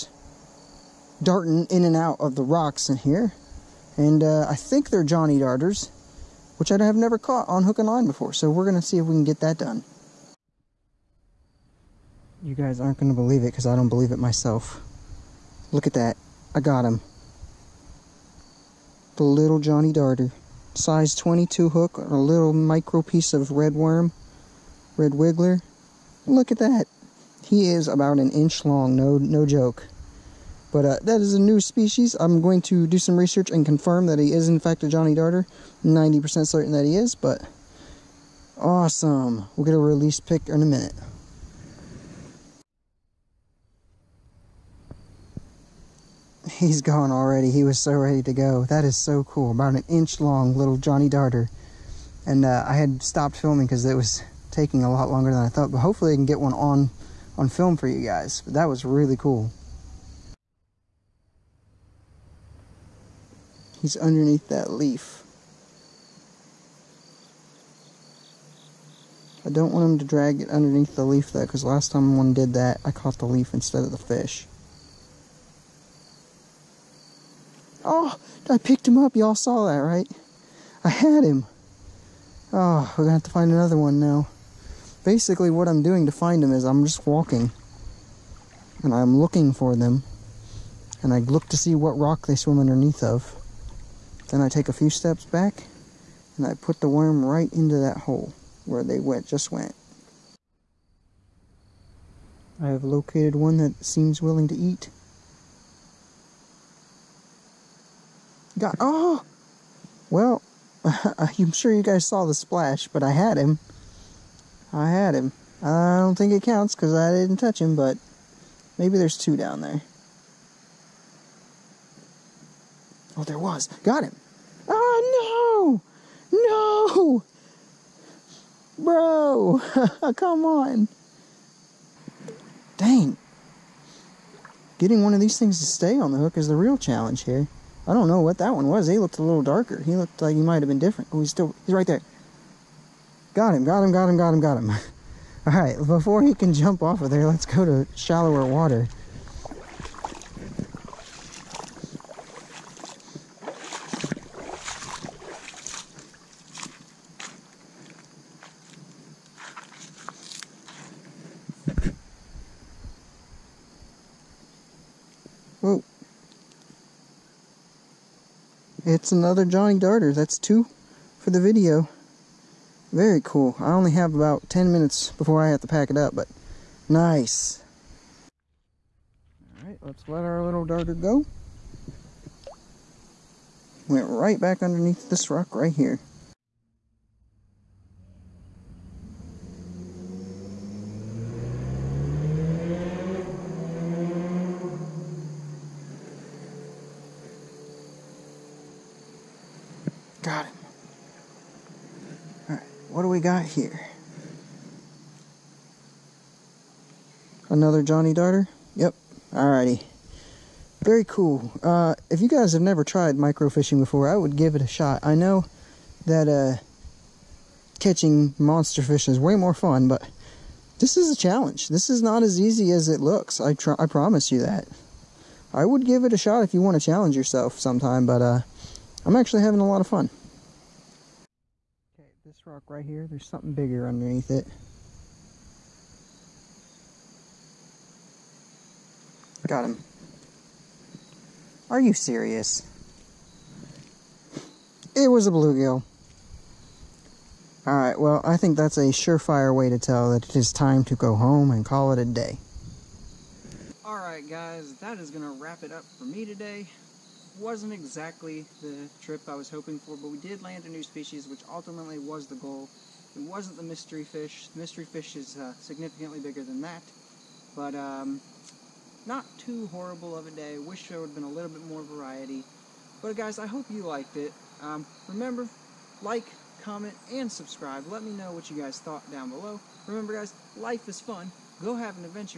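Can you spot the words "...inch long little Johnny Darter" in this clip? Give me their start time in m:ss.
0:49.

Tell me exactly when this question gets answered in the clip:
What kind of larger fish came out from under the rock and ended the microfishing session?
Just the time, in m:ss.
4:05.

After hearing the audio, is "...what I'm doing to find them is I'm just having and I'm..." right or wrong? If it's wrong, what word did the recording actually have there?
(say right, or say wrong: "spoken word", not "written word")
wrong: "walking", not "having".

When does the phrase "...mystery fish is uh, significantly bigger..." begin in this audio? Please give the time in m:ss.
4:24.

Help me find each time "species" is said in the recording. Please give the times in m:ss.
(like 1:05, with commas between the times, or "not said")
0:31, 4:20.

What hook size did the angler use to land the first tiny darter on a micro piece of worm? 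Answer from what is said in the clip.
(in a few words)
Size 22.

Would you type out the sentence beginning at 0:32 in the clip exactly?
I'm going to do some research and confirm that he is in fact a Johnny Darter.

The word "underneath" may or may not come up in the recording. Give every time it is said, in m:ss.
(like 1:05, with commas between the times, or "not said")
1:03, 1:10, 1:32, 3:04, 3:53.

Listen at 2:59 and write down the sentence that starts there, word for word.
All right, let's let our little darter go.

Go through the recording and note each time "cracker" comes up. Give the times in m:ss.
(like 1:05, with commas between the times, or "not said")
not said.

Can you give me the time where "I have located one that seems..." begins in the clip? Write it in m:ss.
1:42.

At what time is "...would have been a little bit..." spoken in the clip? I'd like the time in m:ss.
4:30.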